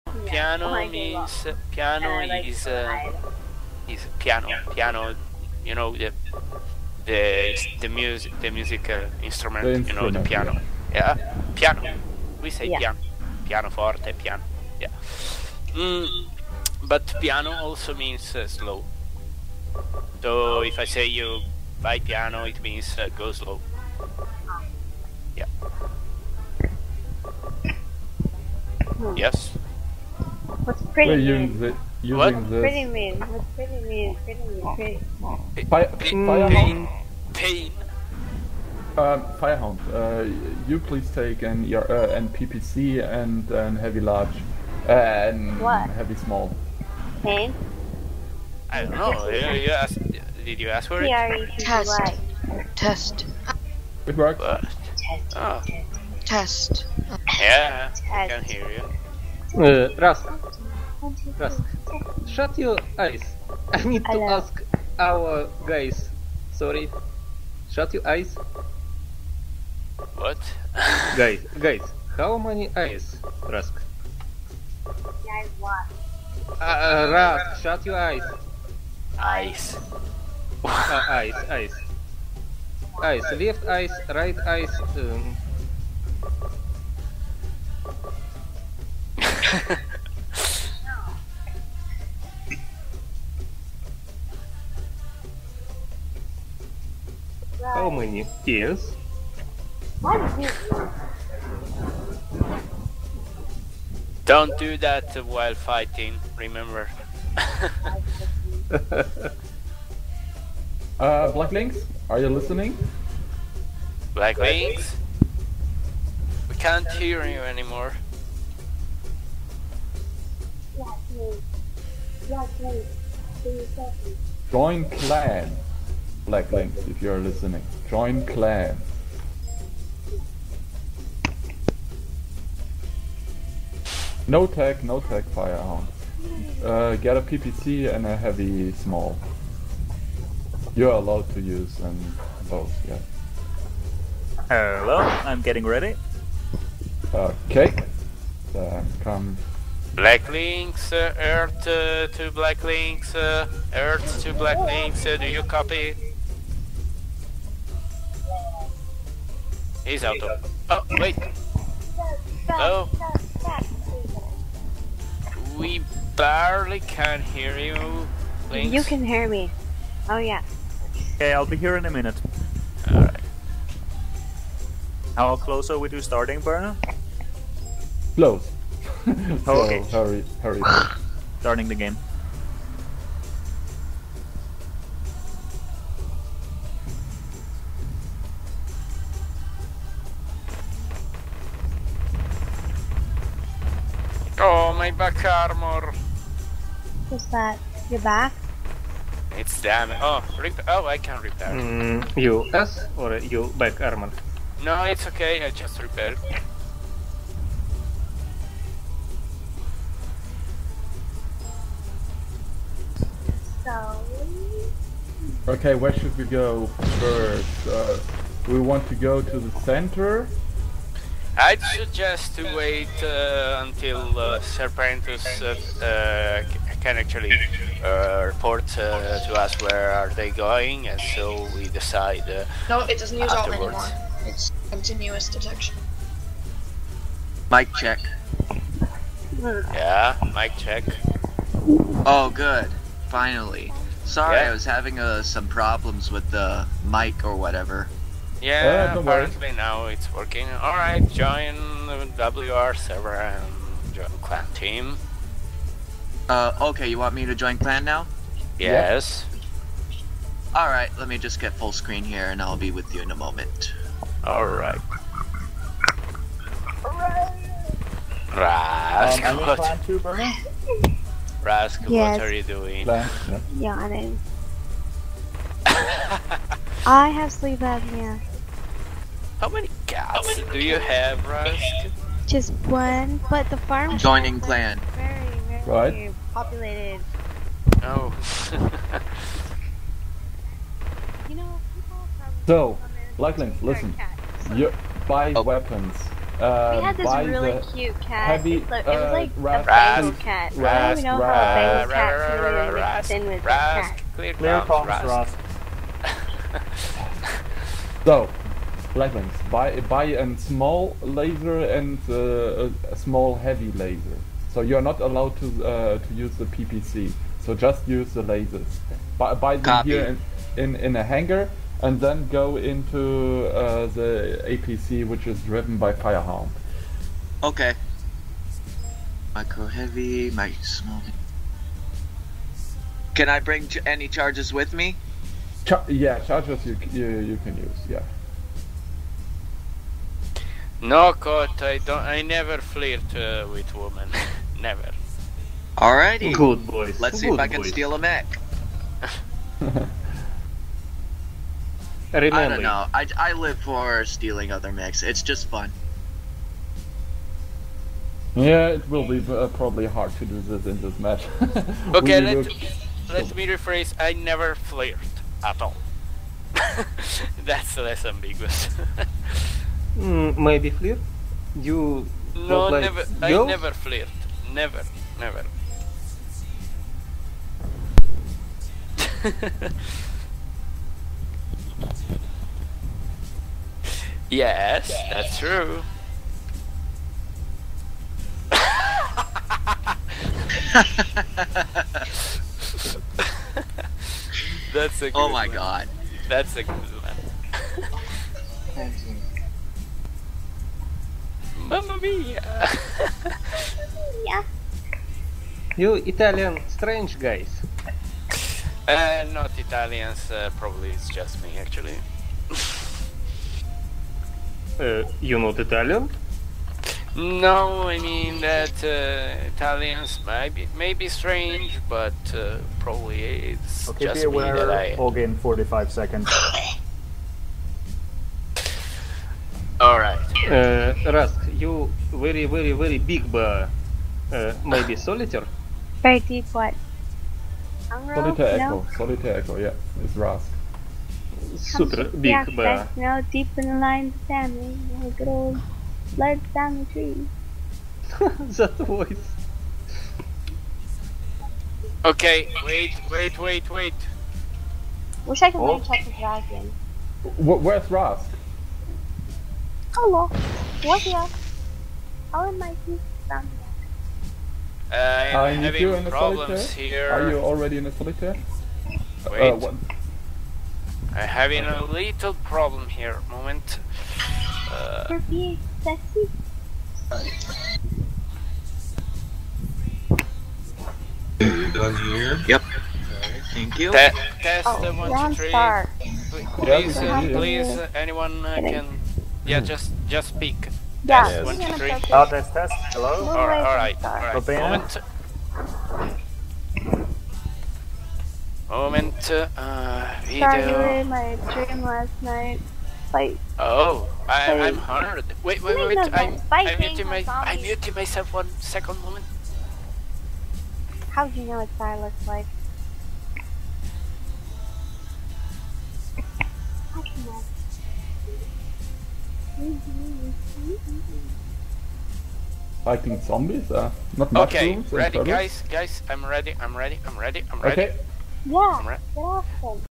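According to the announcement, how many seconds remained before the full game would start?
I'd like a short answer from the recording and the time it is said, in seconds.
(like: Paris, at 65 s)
45, at 425 s.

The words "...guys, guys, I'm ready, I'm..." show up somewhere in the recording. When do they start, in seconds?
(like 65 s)
525 s.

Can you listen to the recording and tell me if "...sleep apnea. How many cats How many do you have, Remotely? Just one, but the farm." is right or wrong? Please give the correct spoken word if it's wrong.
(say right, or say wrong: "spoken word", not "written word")
wrong: "Rask", not "Remotely".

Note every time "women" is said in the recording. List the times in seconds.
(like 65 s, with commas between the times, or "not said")
343 s.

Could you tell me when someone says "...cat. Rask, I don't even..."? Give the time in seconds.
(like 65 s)
300 s.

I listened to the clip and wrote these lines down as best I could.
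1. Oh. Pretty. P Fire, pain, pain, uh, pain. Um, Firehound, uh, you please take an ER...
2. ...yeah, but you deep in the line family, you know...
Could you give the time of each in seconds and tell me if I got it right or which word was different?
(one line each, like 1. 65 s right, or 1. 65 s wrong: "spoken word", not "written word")
1. 35 s right
2. 442 s right.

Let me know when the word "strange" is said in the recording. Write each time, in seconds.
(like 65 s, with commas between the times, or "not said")
406 s, 421 s.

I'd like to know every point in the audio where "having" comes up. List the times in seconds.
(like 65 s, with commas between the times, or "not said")
244 s, 465 s, 471 s.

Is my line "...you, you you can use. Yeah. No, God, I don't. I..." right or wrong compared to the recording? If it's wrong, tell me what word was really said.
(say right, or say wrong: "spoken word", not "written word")
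right.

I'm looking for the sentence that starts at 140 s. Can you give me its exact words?
You're allowed to use and both.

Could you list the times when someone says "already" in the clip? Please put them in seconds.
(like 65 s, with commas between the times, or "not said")
467 s.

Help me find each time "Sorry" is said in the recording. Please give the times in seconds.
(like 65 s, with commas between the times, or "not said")
66 s, 244 s, 500 s.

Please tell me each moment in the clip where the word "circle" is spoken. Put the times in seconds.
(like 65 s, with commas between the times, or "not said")
not said.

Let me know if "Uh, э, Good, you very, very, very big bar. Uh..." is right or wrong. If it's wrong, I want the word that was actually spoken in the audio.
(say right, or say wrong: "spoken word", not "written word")
wrong: "Rask", not "Good".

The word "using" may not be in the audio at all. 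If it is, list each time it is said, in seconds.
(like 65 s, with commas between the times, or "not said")
32 s.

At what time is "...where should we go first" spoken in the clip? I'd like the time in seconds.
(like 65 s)
215 s.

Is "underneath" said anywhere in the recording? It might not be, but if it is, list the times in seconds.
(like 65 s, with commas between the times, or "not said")
not said.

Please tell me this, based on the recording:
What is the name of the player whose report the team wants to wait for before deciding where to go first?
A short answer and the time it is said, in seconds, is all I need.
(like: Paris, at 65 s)
Serpentus, at 224 s.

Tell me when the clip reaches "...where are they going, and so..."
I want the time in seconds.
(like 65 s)
229 s.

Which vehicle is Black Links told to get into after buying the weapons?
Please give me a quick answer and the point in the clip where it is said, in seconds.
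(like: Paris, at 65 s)
APC, at 323 s.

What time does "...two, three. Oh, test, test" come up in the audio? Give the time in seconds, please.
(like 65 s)
491 s.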